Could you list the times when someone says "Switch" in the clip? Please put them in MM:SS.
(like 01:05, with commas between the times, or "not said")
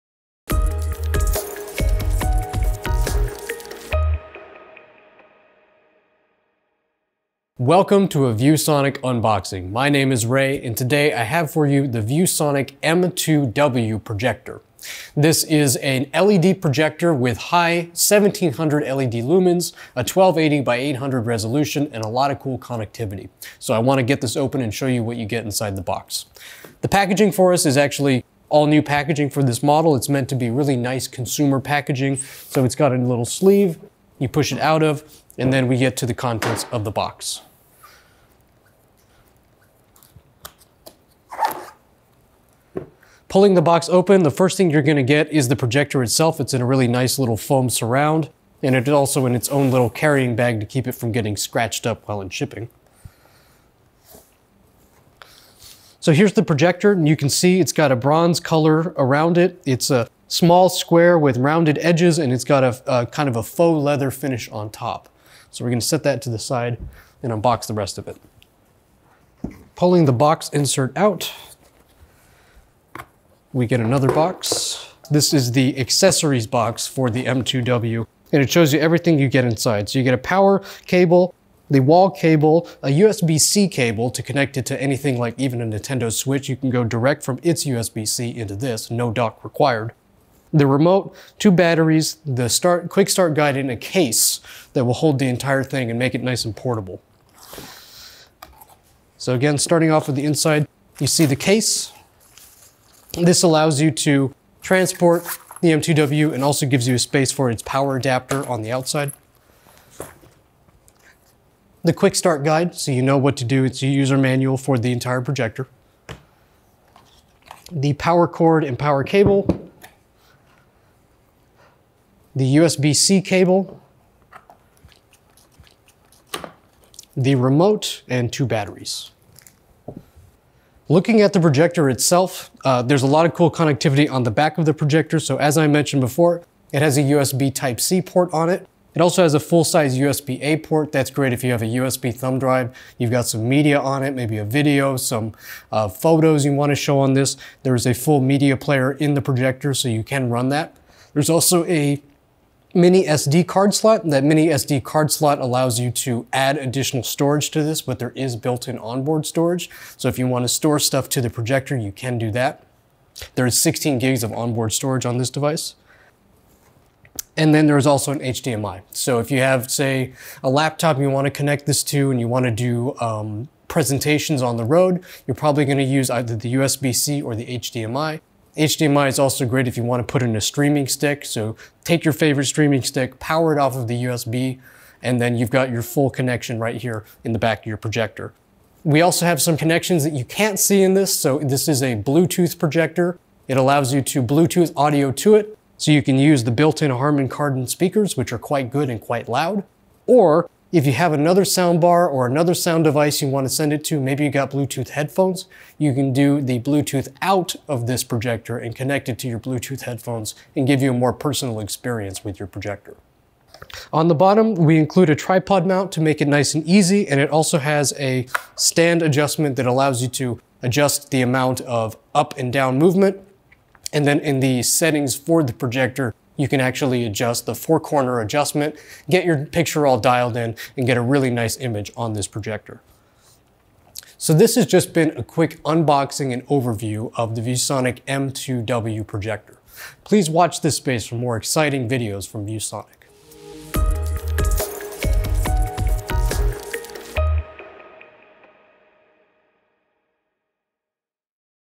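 01:26.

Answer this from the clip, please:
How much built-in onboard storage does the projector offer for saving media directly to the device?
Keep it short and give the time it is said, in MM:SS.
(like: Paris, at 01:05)
16 gigs, at 02:43.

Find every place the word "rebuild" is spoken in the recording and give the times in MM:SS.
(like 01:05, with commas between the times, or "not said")
not said.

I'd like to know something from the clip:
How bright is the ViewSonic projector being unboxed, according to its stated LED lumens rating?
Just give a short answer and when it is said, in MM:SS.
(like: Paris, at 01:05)
1700 LED lumens, at 00:17.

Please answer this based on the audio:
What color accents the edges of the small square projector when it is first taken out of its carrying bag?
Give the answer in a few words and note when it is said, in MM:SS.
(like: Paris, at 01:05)
Bronze, at 00:57.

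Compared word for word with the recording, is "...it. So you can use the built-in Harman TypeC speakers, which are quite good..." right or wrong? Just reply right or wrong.
wrong.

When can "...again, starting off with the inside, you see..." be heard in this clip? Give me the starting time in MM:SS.
01:39.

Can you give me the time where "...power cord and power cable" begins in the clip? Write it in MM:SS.
01:57.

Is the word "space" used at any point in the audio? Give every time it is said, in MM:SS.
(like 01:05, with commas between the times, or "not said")
01:46, 04:00.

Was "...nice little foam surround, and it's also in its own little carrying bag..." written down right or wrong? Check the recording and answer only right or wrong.
right.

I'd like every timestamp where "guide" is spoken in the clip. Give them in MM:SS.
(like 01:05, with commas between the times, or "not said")
01:33, 01:52.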